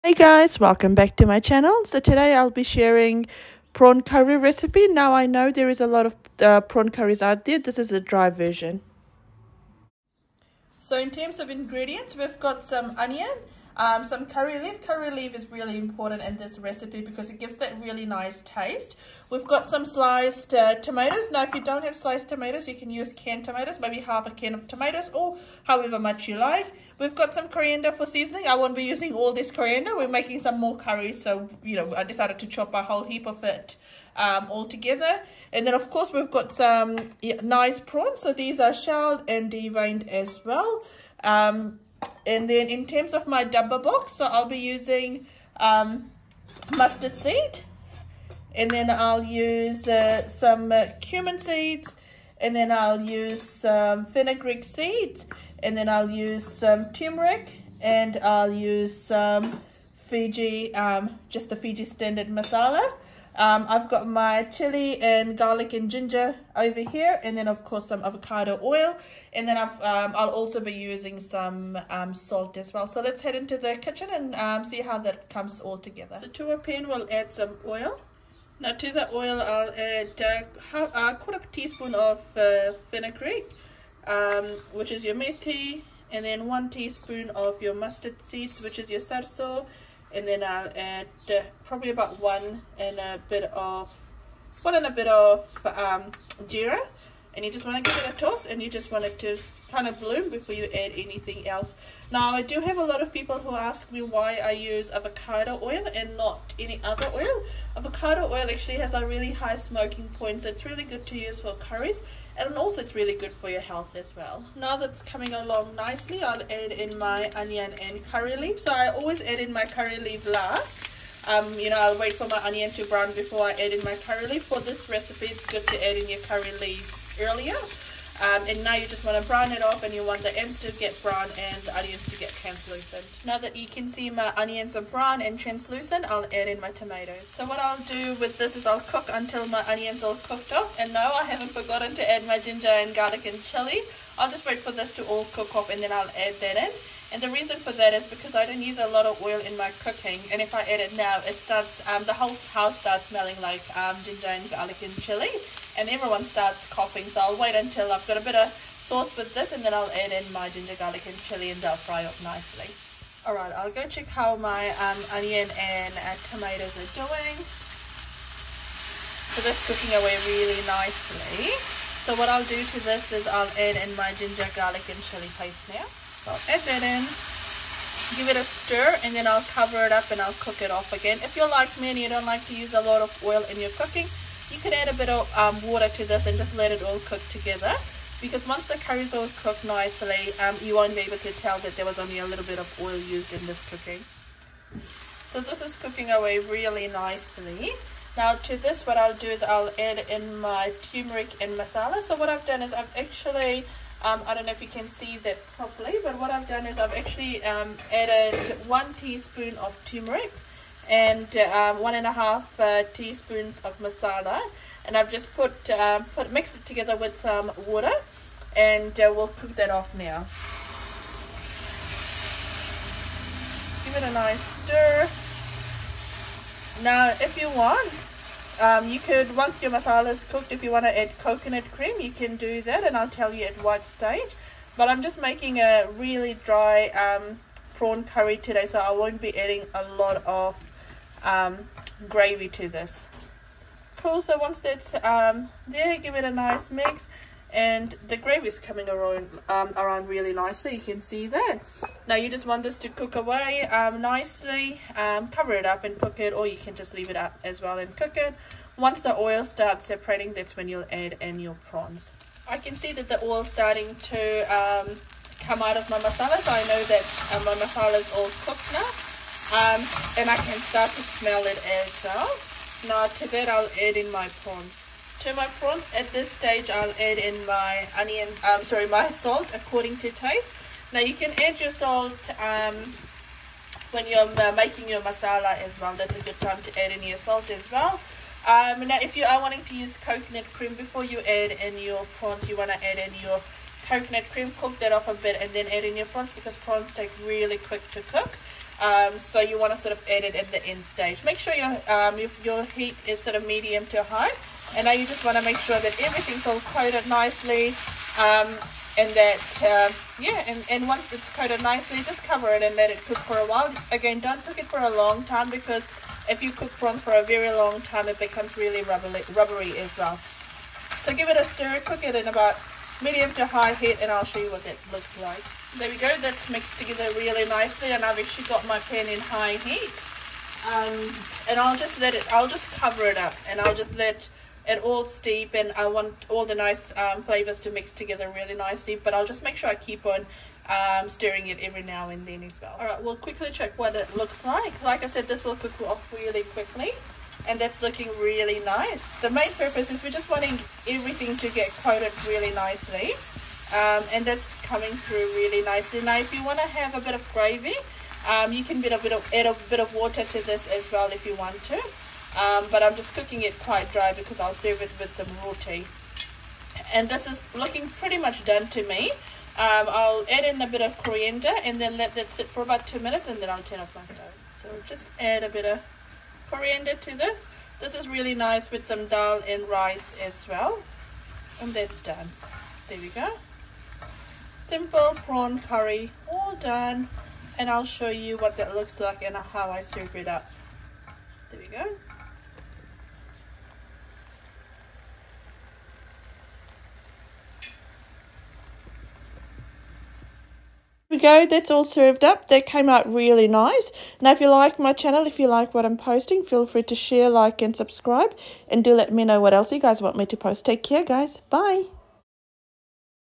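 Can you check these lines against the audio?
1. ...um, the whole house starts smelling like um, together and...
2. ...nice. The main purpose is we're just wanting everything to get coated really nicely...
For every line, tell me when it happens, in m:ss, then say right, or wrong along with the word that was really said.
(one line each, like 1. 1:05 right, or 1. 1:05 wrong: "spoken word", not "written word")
1. 2:31 wrong: "ginger", not "together"
2. 5:48 right.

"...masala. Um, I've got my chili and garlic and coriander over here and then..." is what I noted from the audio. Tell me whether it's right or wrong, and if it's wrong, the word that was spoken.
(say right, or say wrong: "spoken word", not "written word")
wrong: "ginger", not "coriander".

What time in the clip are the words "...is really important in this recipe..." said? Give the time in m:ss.
0:15.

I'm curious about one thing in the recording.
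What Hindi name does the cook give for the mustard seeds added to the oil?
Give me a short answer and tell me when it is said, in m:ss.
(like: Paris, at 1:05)
sarso, at 1:28.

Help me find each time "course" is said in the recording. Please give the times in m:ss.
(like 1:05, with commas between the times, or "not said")
0:35, 1:07.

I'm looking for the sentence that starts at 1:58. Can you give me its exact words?
So I always add in my curry leaf last.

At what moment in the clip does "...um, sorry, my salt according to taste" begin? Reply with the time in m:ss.
4:38.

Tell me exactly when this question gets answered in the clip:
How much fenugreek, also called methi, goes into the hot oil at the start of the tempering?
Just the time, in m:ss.
1:21.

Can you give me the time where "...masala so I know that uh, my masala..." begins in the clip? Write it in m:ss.
4:25.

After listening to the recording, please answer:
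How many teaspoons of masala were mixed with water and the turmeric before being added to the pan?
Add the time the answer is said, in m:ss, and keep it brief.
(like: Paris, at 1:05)
1.5, at 3:31.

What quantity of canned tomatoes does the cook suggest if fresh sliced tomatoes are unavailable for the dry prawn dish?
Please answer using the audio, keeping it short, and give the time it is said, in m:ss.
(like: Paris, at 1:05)
half a can, at 0:24.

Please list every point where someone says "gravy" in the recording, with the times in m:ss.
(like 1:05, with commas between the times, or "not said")
4:02, 4:08, 5:57.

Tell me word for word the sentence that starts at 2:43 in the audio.
Alright, I'll go check how my um, onion and uh, tomatoes are doing.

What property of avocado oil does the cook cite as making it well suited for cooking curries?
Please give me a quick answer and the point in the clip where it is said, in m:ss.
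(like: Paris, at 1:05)
high smoking point, at 1:49.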